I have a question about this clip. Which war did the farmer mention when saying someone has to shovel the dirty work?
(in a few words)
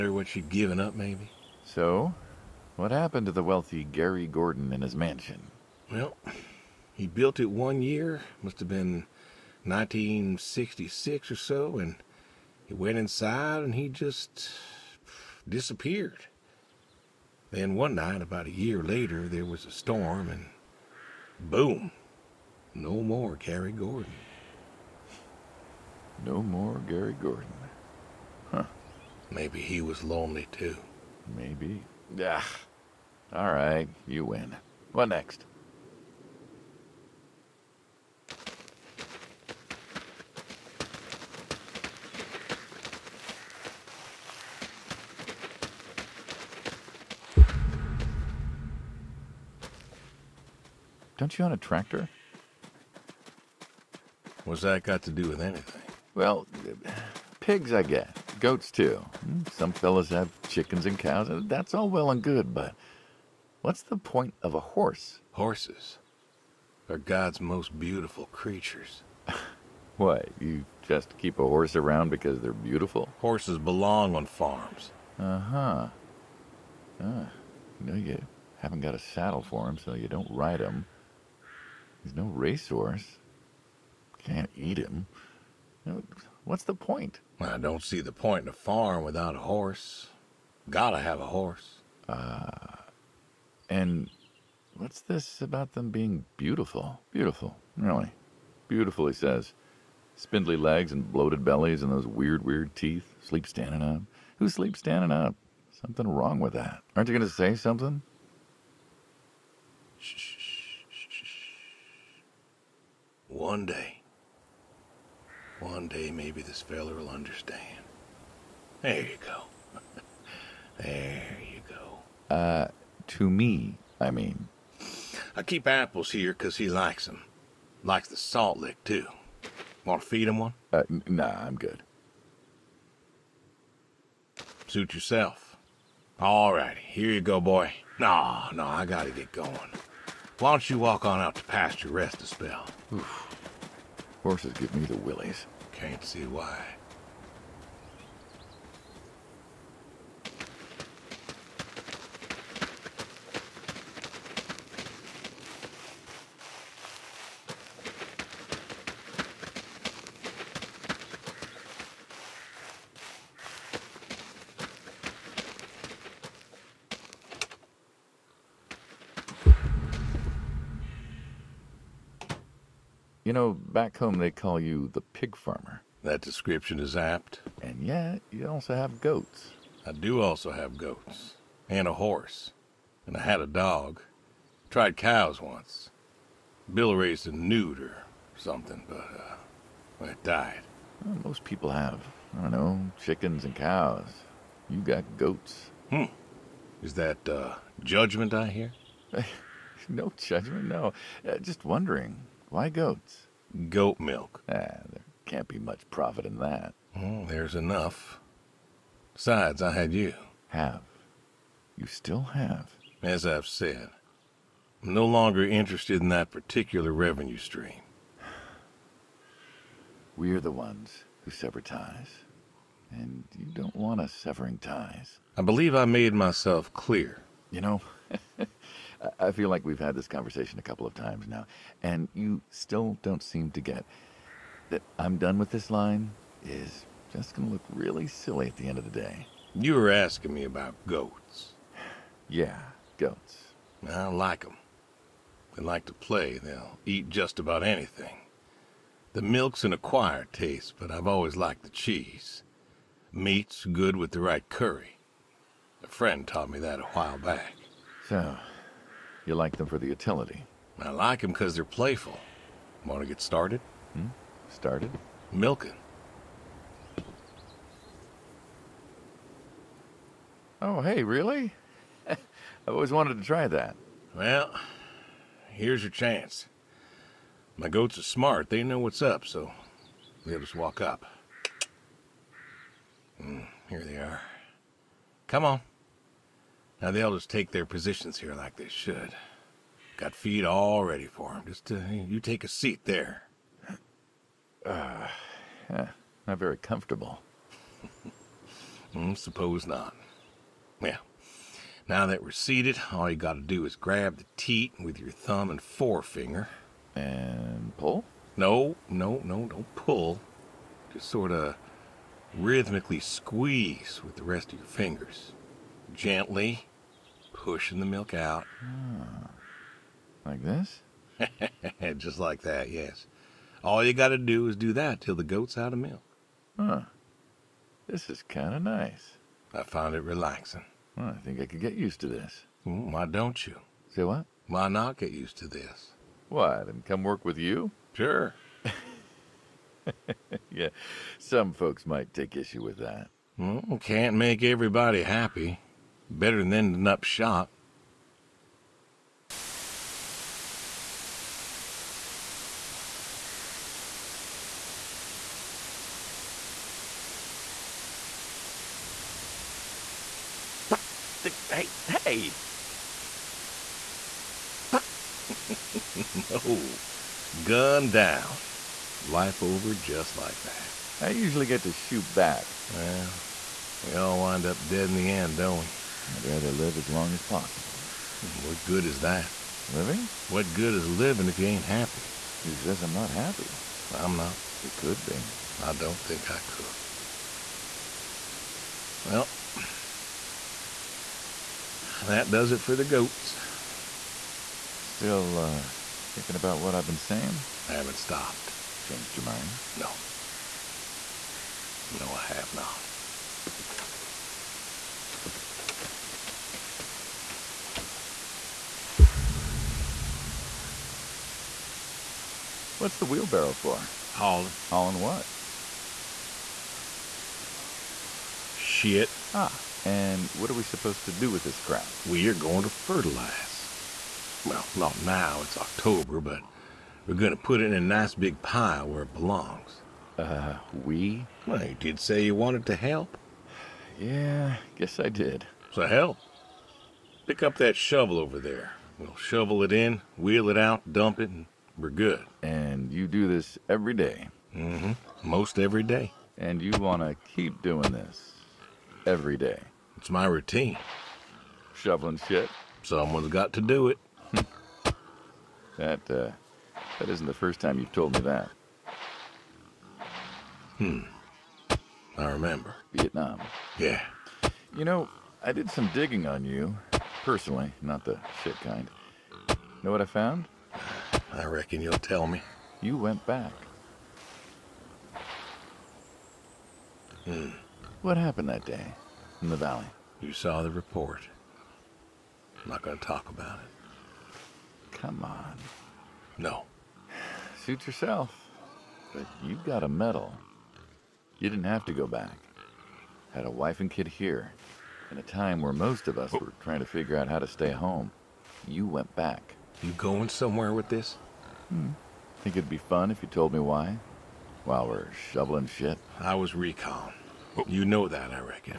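Vietnam.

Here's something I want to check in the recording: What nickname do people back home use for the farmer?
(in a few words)
The pig farmer.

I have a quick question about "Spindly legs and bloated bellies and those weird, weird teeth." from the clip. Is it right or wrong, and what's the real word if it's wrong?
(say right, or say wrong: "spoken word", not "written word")
right.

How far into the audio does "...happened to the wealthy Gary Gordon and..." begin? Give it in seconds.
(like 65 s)
2 s.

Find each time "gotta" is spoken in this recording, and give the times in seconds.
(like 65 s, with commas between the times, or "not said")
90 s, 138 s, 303 s.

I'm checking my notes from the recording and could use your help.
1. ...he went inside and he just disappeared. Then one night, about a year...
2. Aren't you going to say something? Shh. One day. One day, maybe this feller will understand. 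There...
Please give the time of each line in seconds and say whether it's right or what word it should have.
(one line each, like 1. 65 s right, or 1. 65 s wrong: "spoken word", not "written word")
1. 12 s right
2. 106 s right.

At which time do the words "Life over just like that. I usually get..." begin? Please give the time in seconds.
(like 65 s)
369 s.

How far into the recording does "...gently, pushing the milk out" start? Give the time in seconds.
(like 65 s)
315 s.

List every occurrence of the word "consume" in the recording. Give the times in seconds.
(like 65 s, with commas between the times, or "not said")
not said.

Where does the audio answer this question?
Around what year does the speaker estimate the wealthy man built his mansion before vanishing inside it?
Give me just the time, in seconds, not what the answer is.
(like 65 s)
9 s.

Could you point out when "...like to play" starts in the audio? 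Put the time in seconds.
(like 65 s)
245 s.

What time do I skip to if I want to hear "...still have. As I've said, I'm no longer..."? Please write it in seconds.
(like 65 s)
211 s.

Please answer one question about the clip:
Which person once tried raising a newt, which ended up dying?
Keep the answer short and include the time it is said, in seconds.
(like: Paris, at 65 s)
Bill, at 186 s.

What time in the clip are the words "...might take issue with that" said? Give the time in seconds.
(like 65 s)
341 s.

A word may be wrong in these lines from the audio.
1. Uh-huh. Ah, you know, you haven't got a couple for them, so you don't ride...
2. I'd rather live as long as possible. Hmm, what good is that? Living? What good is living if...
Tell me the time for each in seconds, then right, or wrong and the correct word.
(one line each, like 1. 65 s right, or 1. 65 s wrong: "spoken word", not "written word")
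1. 75 s wrong: "saddle", not "couple"
2. 376 s right.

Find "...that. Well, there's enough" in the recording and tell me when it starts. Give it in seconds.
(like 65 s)
206 s.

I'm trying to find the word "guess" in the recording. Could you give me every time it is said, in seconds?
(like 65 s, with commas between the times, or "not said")
57 s, 434 s.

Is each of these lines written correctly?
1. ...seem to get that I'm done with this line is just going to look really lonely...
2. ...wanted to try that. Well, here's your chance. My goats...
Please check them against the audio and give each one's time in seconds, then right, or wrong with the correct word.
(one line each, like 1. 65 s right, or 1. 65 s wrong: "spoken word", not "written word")
1. 233 s wrong: "silly", not "lonely"
2. 272 s right.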